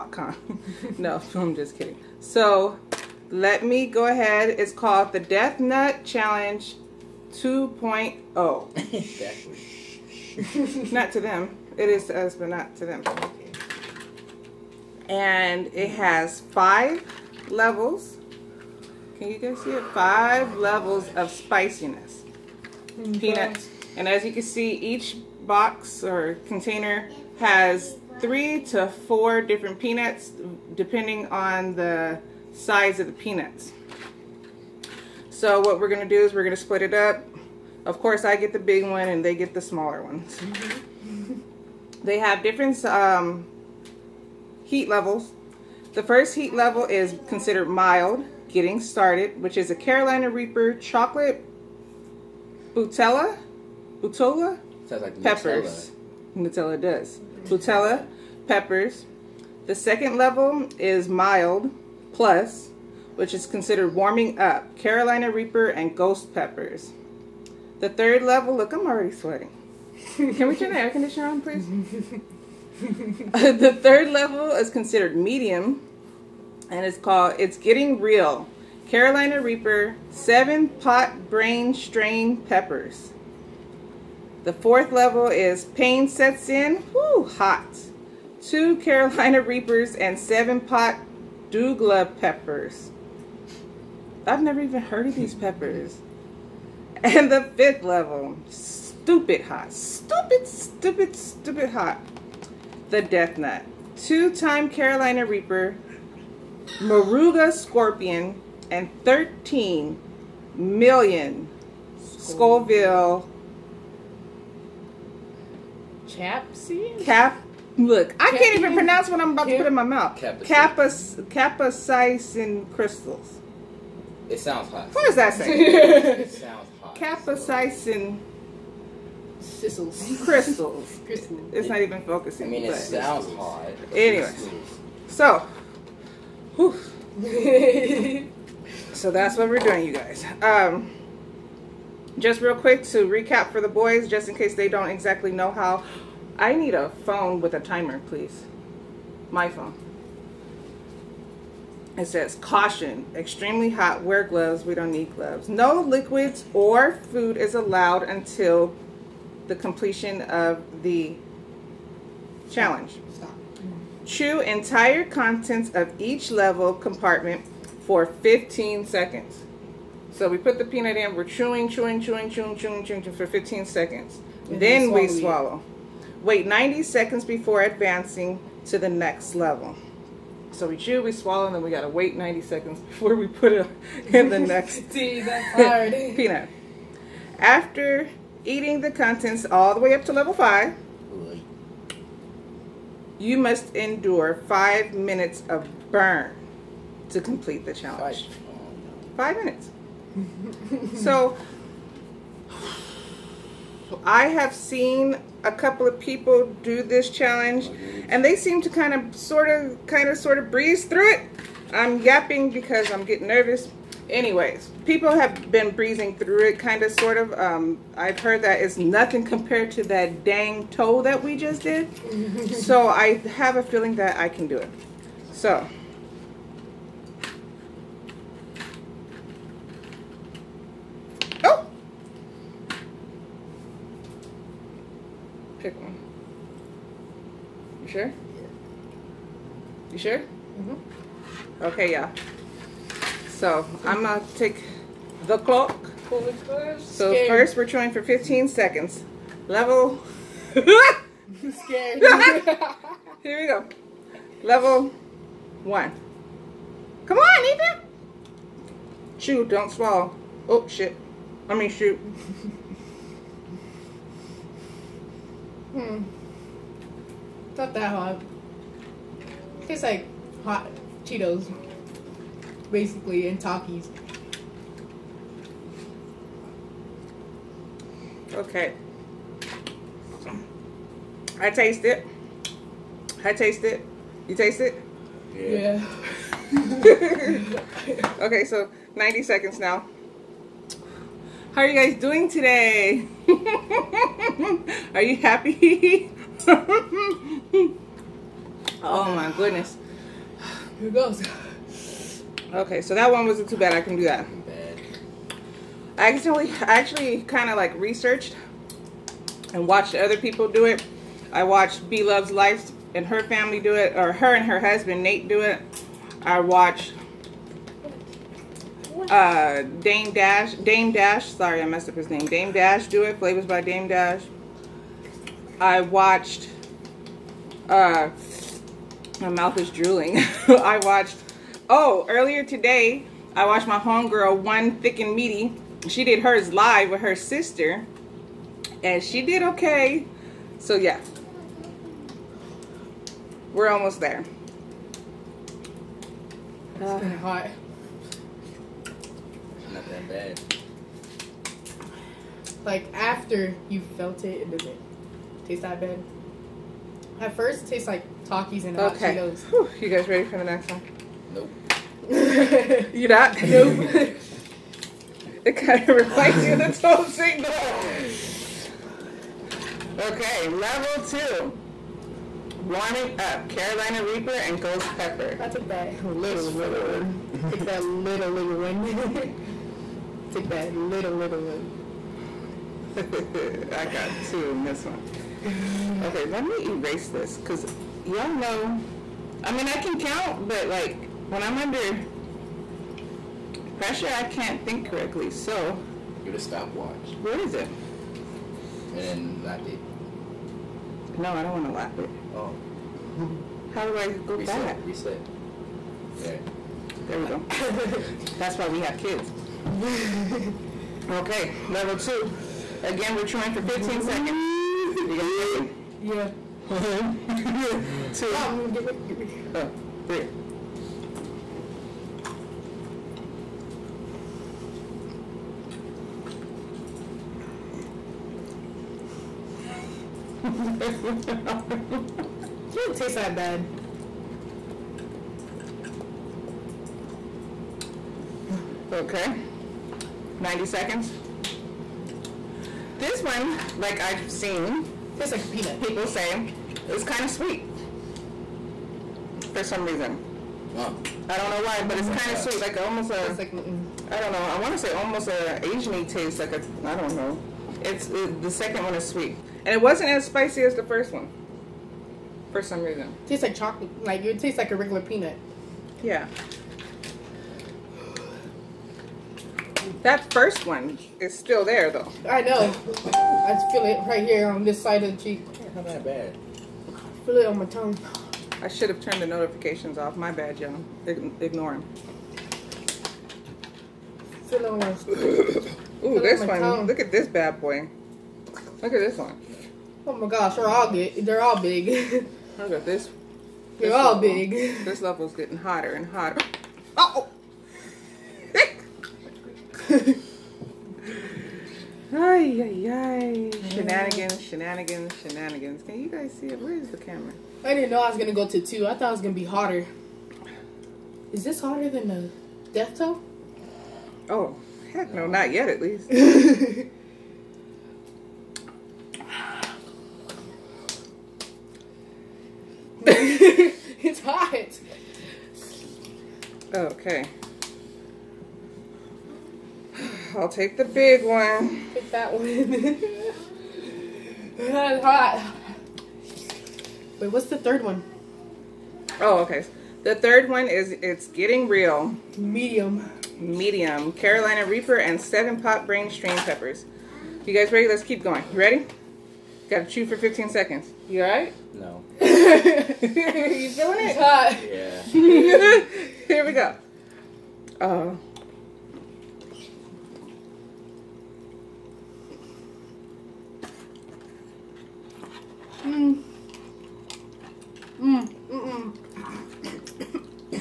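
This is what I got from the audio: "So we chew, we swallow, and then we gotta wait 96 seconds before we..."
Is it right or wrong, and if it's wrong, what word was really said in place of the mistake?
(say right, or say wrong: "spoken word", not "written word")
wrong: "90", not "96".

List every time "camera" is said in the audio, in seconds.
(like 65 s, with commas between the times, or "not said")
506 s.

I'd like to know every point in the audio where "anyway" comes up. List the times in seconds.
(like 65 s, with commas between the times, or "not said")
133 s, 214 s.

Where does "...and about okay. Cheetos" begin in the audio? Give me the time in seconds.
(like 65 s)
358 s.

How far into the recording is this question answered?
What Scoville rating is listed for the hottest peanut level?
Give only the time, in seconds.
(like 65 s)
109 s.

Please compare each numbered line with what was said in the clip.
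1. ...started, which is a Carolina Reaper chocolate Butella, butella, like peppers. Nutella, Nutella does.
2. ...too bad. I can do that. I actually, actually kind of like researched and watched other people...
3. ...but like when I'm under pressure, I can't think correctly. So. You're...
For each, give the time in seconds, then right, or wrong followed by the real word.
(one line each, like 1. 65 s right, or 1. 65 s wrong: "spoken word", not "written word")
1. 48 s right
2. 303 s right
3. 390 s right.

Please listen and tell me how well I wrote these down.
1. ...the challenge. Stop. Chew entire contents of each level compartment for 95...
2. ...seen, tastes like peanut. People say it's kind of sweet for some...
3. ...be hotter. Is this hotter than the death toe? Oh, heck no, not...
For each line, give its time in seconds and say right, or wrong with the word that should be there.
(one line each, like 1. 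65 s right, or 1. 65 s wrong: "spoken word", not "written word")
1. 160 s wrong: "15", not "95"
2. 444 s right
3. 509 s right.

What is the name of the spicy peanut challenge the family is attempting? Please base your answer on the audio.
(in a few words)
Death Nut Challenge 2.0.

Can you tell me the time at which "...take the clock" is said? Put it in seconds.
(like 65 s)
244 s.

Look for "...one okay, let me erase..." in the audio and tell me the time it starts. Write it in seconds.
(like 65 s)
384 s.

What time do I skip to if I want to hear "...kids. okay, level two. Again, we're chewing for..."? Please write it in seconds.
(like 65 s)
408 s.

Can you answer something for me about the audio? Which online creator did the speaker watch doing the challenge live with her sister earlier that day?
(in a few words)
One Thick and Meaty.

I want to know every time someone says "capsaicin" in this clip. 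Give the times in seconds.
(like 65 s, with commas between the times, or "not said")
120 s, 126 s.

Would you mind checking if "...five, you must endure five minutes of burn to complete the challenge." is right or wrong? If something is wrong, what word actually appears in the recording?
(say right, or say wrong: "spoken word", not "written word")
right.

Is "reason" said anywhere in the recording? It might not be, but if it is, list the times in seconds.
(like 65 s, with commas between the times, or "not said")
449 s, 462 s.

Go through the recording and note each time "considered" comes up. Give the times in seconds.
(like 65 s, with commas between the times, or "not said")
47 s, 63 s, 74 s.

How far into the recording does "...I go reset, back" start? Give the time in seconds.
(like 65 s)
403 s.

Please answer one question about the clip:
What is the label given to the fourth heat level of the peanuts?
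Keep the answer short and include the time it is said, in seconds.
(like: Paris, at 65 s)
Pain Sets In, at 85 s.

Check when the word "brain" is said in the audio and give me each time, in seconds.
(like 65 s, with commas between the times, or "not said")
81 s, 545 s.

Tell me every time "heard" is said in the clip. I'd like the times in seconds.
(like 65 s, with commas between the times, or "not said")
94 s, 218 s.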